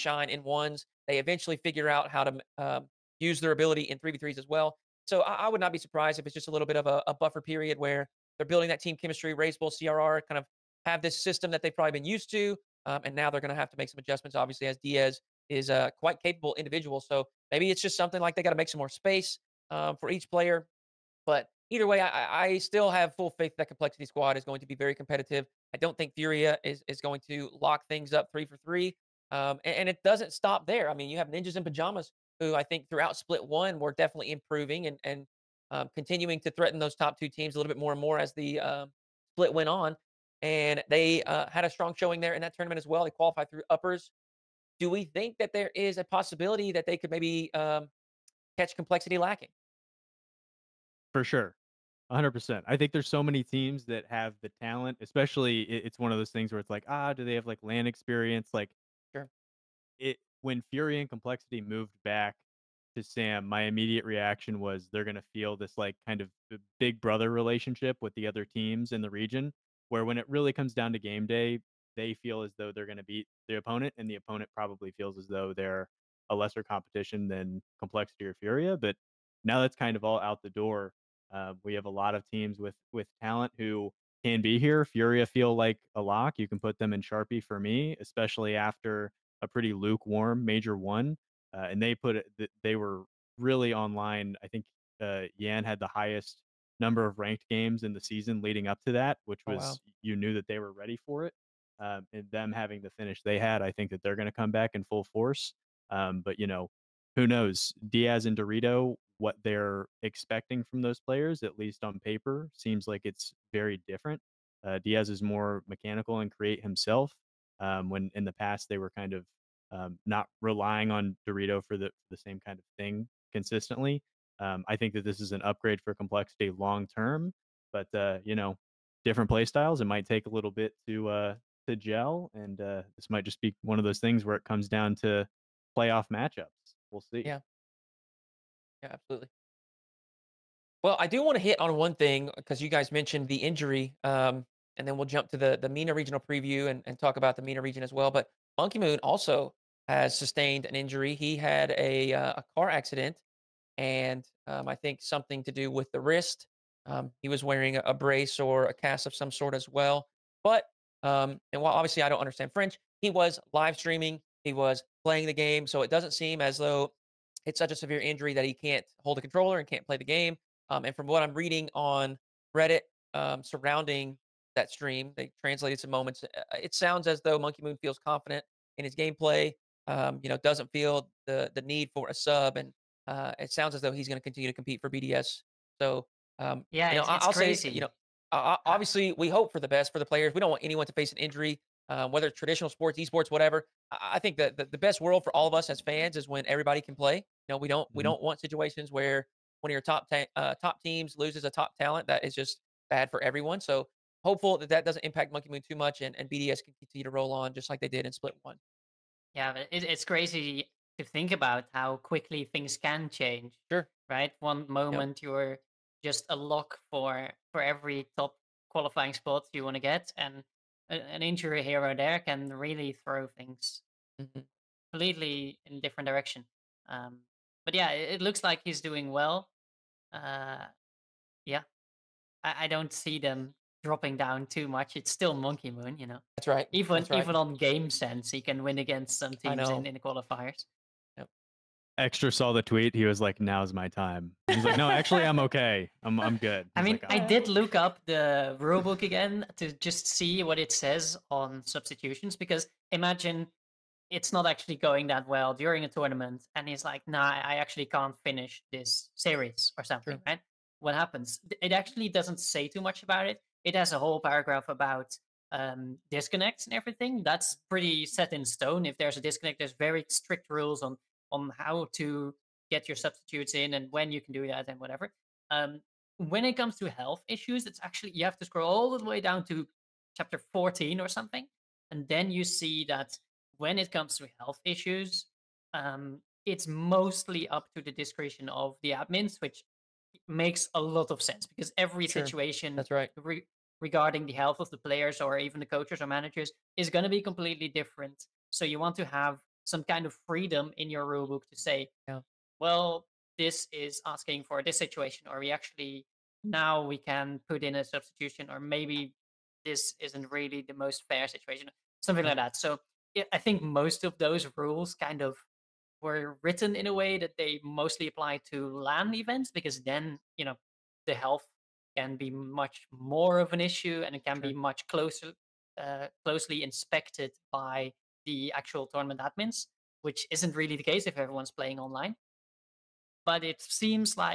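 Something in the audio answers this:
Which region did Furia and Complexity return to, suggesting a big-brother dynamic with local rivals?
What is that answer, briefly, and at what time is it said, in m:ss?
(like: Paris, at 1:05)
SAM, at 1:03.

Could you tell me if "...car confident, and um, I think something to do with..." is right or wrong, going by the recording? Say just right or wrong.
wrong.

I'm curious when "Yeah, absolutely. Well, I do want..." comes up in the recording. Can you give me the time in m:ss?
2:18.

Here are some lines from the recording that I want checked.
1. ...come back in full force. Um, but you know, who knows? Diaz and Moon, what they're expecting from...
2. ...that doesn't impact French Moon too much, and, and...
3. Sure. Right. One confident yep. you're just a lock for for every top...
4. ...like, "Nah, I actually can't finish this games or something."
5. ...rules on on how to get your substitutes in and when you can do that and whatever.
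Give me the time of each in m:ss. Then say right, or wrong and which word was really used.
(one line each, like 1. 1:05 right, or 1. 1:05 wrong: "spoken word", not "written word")
1. 1:44 wrong: "Dorito", not "Moon"
2. 3:24 wrong: "Monkey", not "French"
3. 3:33 wrong: "moment", not "confident"
4. 4:16 wrong: "series", not "games"
5. 4:30 right.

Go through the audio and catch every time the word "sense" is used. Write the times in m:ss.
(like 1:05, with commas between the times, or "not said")
3:57, 4:51.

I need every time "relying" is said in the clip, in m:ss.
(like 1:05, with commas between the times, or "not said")
2:00.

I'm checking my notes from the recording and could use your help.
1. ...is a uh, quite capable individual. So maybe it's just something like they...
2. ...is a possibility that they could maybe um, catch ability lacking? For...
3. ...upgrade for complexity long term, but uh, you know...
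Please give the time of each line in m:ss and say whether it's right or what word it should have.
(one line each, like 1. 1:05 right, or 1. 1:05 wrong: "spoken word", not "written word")
1. 0:15 right
2. 0:45 wrong: "complexity", not "ability"
3. 2:05 right.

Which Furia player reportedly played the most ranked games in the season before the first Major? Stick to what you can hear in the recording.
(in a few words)
Yan.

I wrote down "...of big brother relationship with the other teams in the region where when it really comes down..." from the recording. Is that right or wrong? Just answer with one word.
right.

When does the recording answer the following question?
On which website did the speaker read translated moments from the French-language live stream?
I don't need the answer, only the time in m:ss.
2:52.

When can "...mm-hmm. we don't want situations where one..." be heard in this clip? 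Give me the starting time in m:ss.
3:17.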